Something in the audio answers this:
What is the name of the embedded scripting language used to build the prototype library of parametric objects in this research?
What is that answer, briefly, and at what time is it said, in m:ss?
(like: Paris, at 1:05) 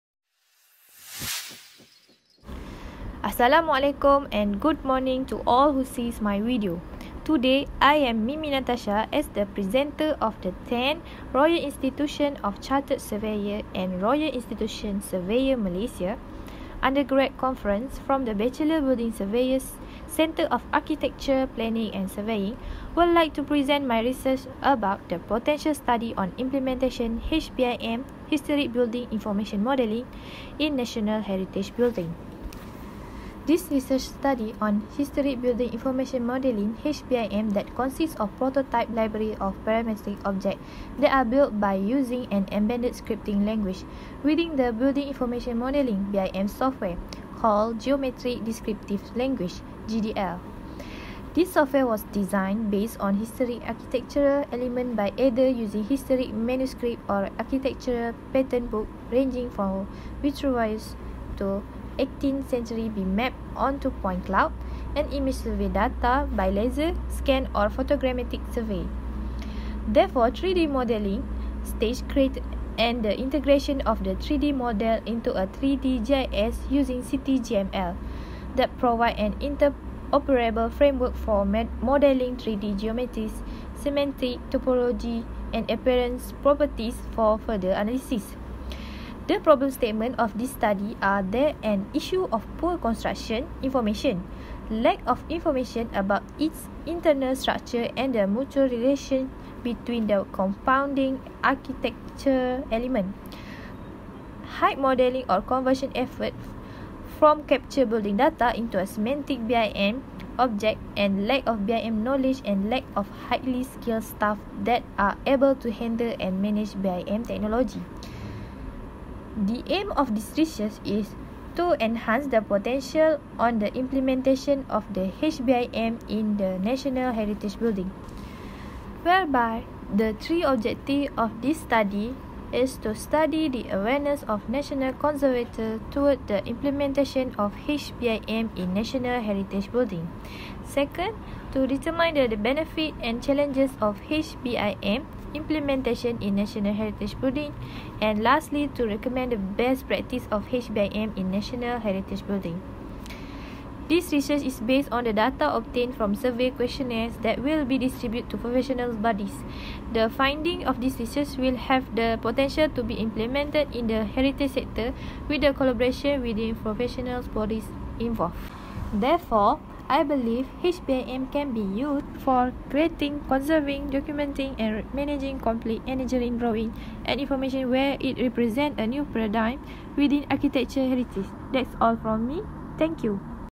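Geometric Descriptive Language, at 0:47.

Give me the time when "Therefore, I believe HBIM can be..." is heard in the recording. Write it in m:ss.
2:48.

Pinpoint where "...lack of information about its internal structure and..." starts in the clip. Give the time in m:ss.
1:34.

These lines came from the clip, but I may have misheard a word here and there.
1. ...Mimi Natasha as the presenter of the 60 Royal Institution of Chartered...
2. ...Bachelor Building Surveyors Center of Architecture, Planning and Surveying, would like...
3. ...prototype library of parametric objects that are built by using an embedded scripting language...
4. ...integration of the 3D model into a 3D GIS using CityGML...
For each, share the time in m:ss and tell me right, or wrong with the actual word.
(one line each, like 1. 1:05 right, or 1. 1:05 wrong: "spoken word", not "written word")
1. 0:08 wrong: "10", not "60"
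2. 0:18 right
3. 0:38 right
4. 1:13 right.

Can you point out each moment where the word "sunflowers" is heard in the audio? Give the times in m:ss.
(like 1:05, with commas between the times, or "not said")
not said.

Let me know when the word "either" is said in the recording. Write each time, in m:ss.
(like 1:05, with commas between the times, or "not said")
0:55.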